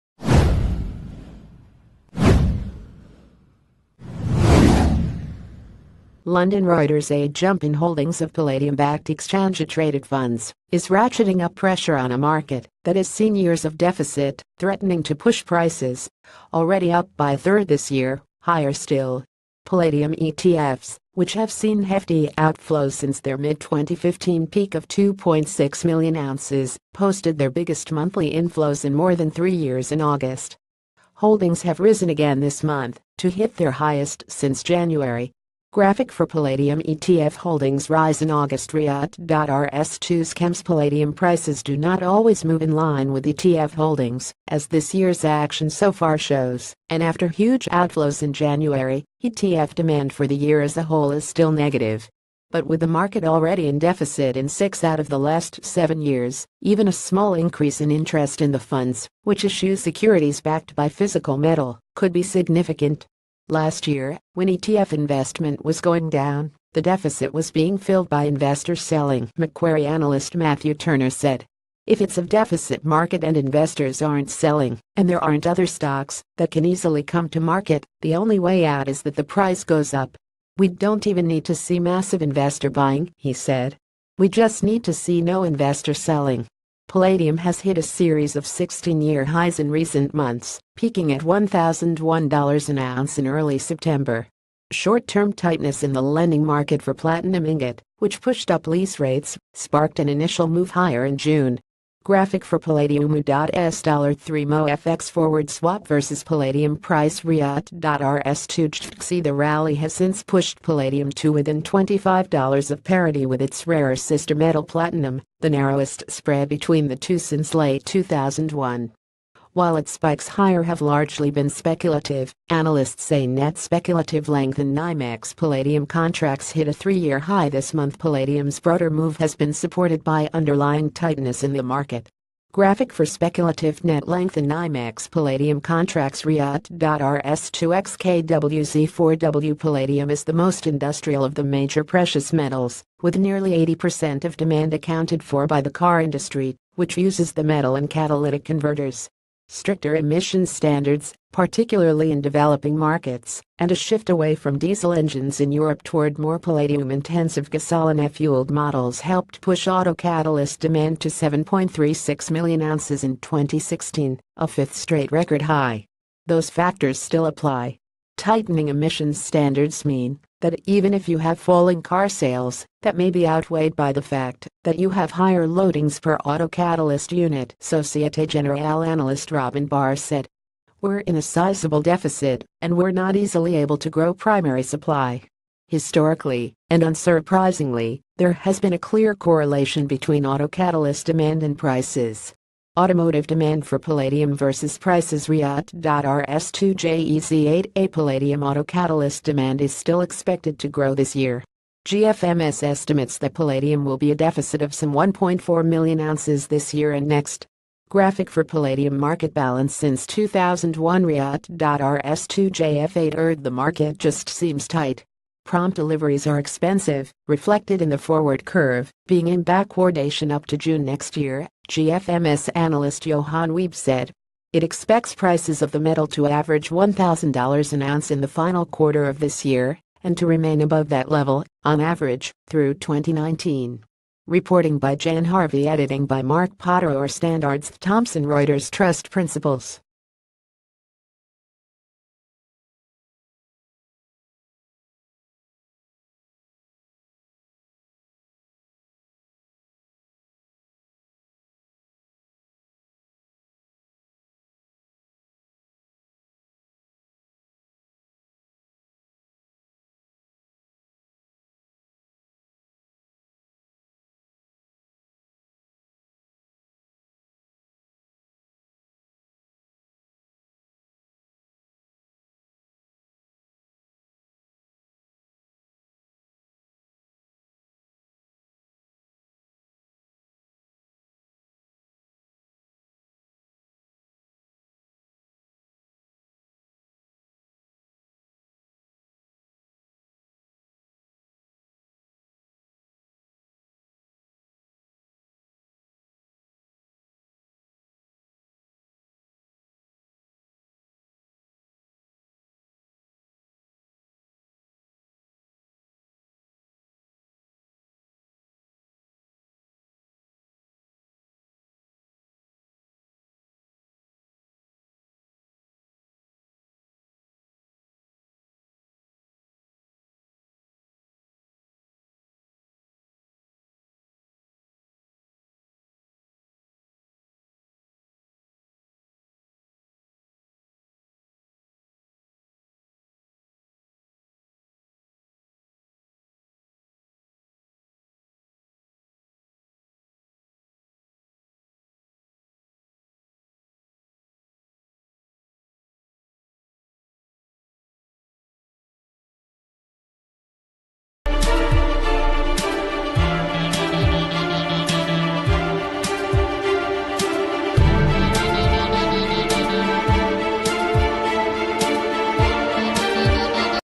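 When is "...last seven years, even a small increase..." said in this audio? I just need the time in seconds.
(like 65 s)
55 s.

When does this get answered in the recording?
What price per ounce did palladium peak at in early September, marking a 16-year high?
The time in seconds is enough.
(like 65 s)
91 s.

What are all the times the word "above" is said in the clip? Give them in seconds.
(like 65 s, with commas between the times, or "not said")
230 s.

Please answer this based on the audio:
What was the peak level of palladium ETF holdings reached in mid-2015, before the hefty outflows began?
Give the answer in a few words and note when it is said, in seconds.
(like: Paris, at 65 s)
2.6 million ounces, at 24 s.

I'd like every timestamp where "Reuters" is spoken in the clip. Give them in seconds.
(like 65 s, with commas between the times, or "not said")
6 s, 238 s.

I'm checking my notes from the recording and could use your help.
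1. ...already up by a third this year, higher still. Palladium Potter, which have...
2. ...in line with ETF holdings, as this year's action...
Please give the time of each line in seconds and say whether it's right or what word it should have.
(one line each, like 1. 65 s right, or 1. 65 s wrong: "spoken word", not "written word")
1. 16 s wrong: "ETFs", not "Potter"
2. 42 s right.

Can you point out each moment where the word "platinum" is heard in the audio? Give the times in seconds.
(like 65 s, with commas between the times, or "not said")
96 s, 114 s.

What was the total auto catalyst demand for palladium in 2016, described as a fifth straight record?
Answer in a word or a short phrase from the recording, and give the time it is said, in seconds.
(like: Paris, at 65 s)
7.36 million ounces, at 161 s.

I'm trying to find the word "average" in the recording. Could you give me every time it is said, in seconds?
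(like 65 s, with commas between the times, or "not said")
226 s, 231 s.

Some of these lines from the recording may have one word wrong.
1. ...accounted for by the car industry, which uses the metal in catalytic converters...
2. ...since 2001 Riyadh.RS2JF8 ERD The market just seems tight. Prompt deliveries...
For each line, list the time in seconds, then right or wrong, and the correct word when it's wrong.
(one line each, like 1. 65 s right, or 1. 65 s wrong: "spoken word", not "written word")
1. 144 s right
2. 209 s right.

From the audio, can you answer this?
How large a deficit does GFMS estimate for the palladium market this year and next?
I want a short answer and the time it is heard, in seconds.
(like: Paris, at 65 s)
1.4 million ounces, at 204 s.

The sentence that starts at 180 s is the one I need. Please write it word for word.
We're in a sizable deficit, and we're not easily able to grow primary supply.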